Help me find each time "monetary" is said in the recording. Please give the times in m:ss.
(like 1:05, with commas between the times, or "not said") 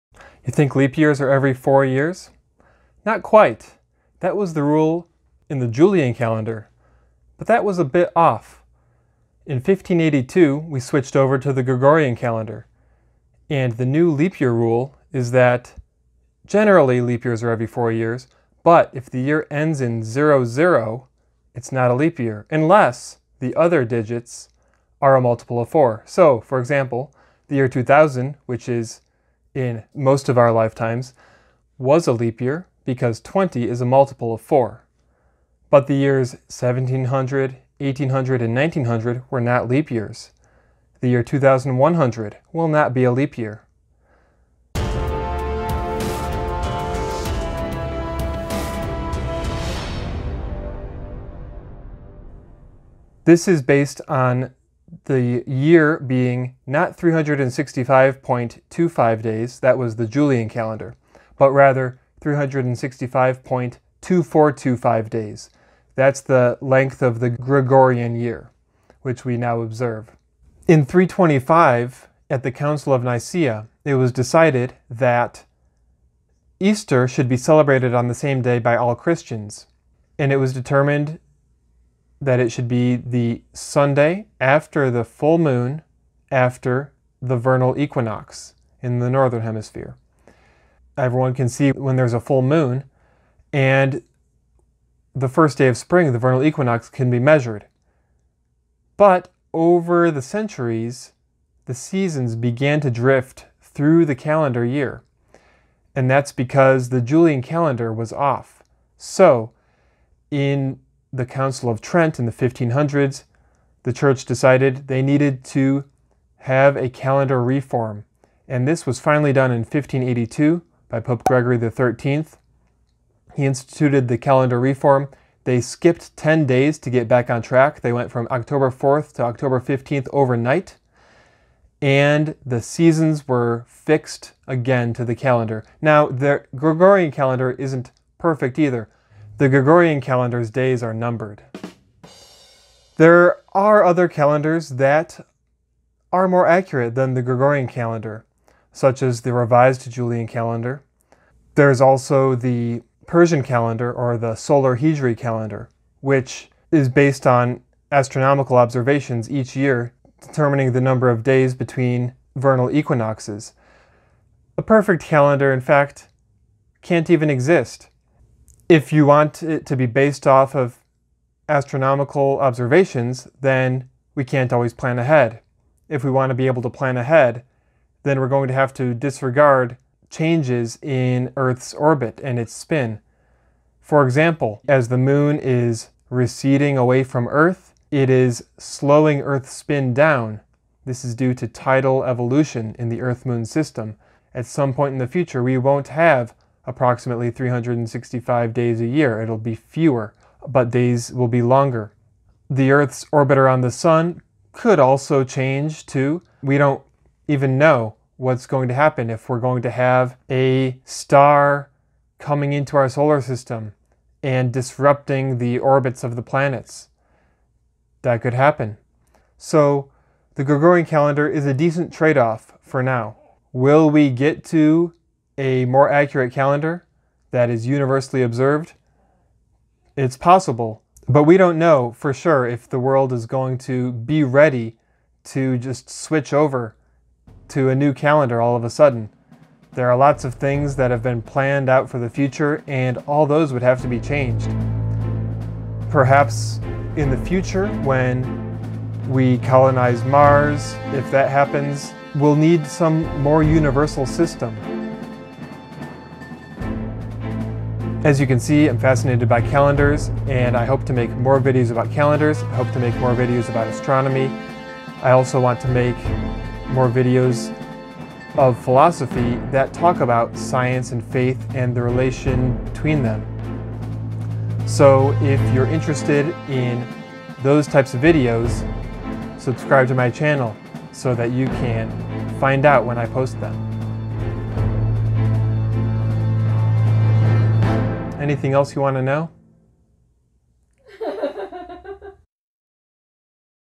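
not said.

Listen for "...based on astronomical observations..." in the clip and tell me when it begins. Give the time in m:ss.
2:36.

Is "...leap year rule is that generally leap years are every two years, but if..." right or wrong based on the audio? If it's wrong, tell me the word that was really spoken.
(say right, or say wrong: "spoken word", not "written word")
wrong: "four", not "two".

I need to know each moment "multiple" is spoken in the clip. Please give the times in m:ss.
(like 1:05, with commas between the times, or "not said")
0:25, 0:33.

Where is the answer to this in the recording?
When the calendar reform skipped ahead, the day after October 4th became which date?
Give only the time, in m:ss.
2:09.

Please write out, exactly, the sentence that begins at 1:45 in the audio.
And that's because the Julian calendar was off.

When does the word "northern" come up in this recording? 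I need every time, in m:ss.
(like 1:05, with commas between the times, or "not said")
1:29.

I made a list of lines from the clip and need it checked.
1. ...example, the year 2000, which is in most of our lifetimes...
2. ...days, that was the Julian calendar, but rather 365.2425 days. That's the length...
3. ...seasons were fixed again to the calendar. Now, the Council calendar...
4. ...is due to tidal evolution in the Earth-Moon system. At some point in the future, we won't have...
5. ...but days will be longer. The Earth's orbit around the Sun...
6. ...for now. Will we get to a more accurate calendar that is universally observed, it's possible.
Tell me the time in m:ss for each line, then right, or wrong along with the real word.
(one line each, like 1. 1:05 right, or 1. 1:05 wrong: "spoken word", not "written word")
1. 0:26 right
2. 0:59 right
3. 2:12 wrong: "Gregorian", not "Council"
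4. 3:11 right
5. 3:20 right
6. 3:42 right.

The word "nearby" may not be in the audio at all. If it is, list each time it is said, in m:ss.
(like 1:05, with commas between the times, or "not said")
not said.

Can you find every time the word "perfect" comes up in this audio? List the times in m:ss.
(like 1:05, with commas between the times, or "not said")
2:18, 2:44.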